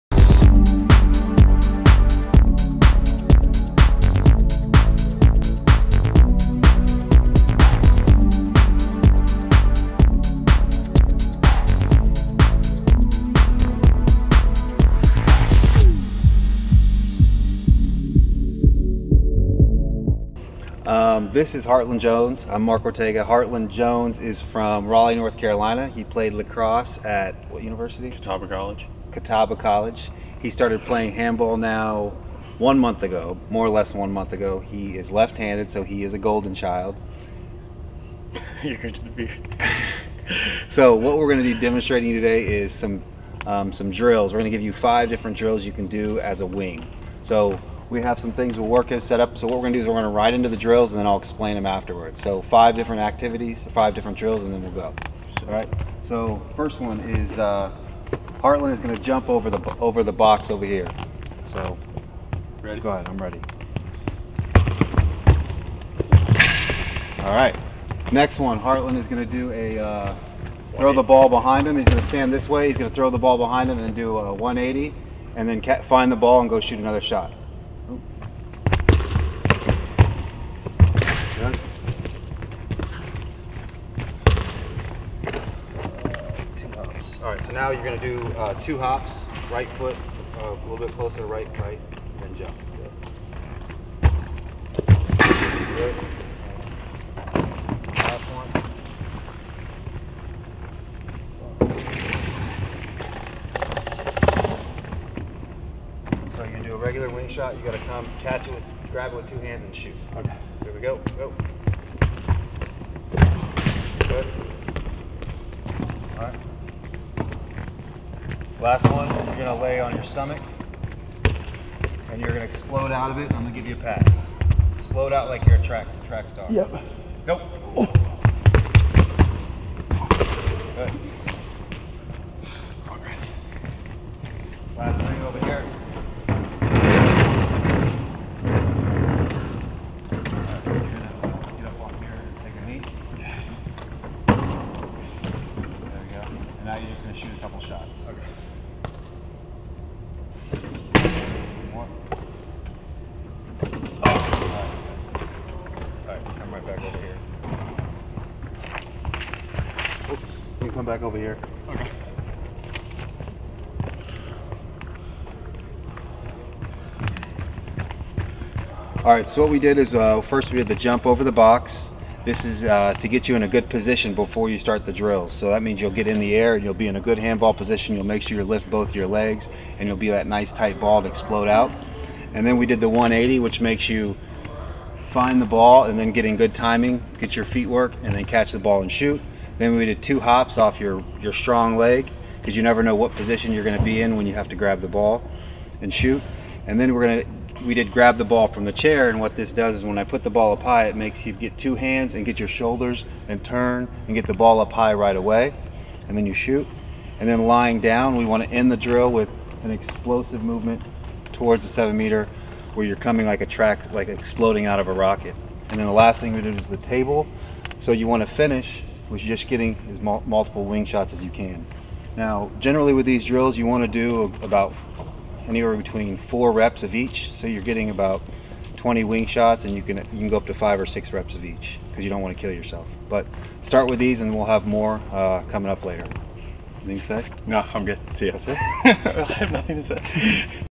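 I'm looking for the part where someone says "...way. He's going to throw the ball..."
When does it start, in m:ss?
1:12.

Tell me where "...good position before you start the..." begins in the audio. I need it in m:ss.
2:53.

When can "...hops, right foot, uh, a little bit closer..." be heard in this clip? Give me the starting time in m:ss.
1:28.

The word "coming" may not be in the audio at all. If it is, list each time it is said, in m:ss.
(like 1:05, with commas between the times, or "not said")
3:32, 3:55.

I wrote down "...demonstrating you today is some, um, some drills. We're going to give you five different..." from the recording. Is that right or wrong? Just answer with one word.
right.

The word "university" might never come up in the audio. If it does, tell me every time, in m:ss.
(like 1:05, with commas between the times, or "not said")
0:27.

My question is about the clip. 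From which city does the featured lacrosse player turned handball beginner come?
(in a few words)
Raleigh.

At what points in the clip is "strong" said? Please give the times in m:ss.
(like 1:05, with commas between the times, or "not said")
3:11.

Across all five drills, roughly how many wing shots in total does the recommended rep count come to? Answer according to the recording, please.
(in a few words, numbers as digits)
20.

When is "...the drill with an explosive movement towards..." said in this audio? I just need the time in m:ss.
3:28.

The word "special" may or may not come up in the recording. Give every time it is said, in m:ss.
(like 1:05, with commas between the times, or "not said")
not said.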